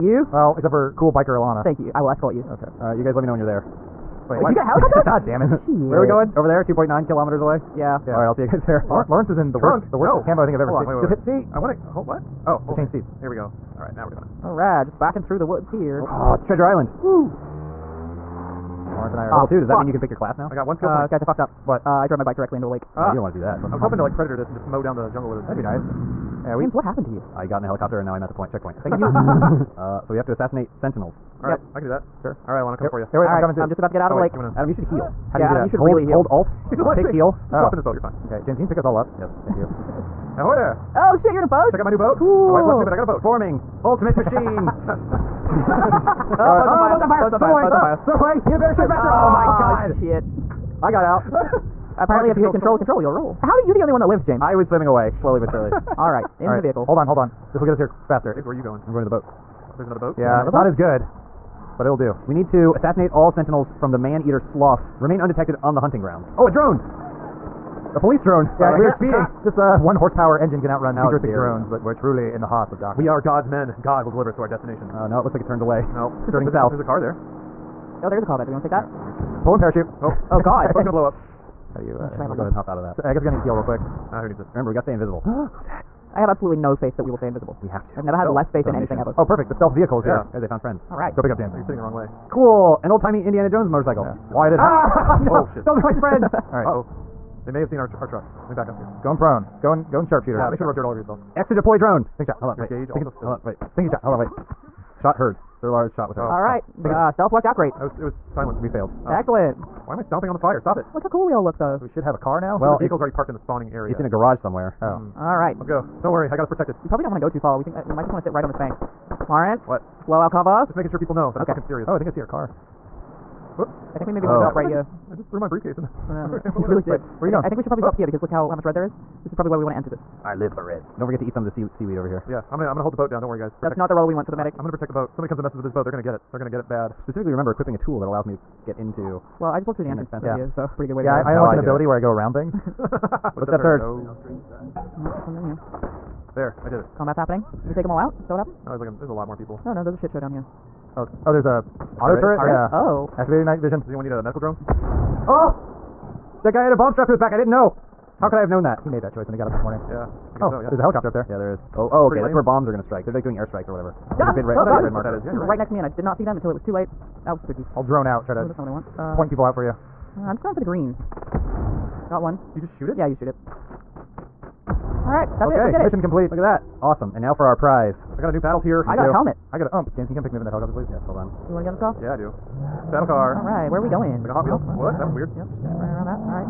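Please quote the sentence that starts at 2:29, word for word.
Oh no, there's a shit show down here.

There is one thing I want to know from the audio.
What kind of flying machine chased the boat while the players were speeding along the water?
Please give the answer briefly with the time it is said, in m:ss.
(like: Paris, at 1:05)
A police drone, at 1:07.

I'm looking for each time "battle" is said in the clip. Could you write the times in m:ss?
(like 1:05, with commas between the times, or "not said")
2:58, 3:02.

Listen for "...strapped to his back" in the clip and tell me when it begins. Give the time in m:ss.
2:36.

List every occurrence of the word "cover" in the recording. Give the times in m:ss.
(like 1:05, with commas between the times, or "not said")
2:00.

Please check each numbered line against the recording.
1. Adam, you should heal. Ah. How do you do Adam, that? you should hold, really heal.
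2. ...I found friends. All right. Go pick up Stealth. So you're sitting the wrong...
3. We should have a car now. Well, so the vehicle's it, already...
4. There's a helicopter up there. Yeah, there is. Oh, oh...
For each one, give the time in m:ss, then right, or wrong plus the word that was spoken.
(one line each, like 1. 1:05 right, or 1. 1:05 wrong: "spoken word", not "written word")
1. 0:34 right
2. 1:30 wrong: "James", not "Stealth"
3. 1:51 right
4. 2:40 right.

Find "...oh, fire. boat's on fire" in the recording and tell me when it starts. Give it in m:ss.
0:46.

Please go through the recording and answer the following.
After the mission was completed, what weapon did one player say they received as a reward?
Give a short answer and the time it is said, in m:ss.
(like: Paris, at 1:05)
UMP, at 2:59.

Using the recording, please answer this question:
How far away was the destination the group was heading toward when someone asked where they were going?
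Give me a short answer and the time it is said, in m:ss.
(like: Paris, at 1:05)
2.9 kilometers, at 0:06.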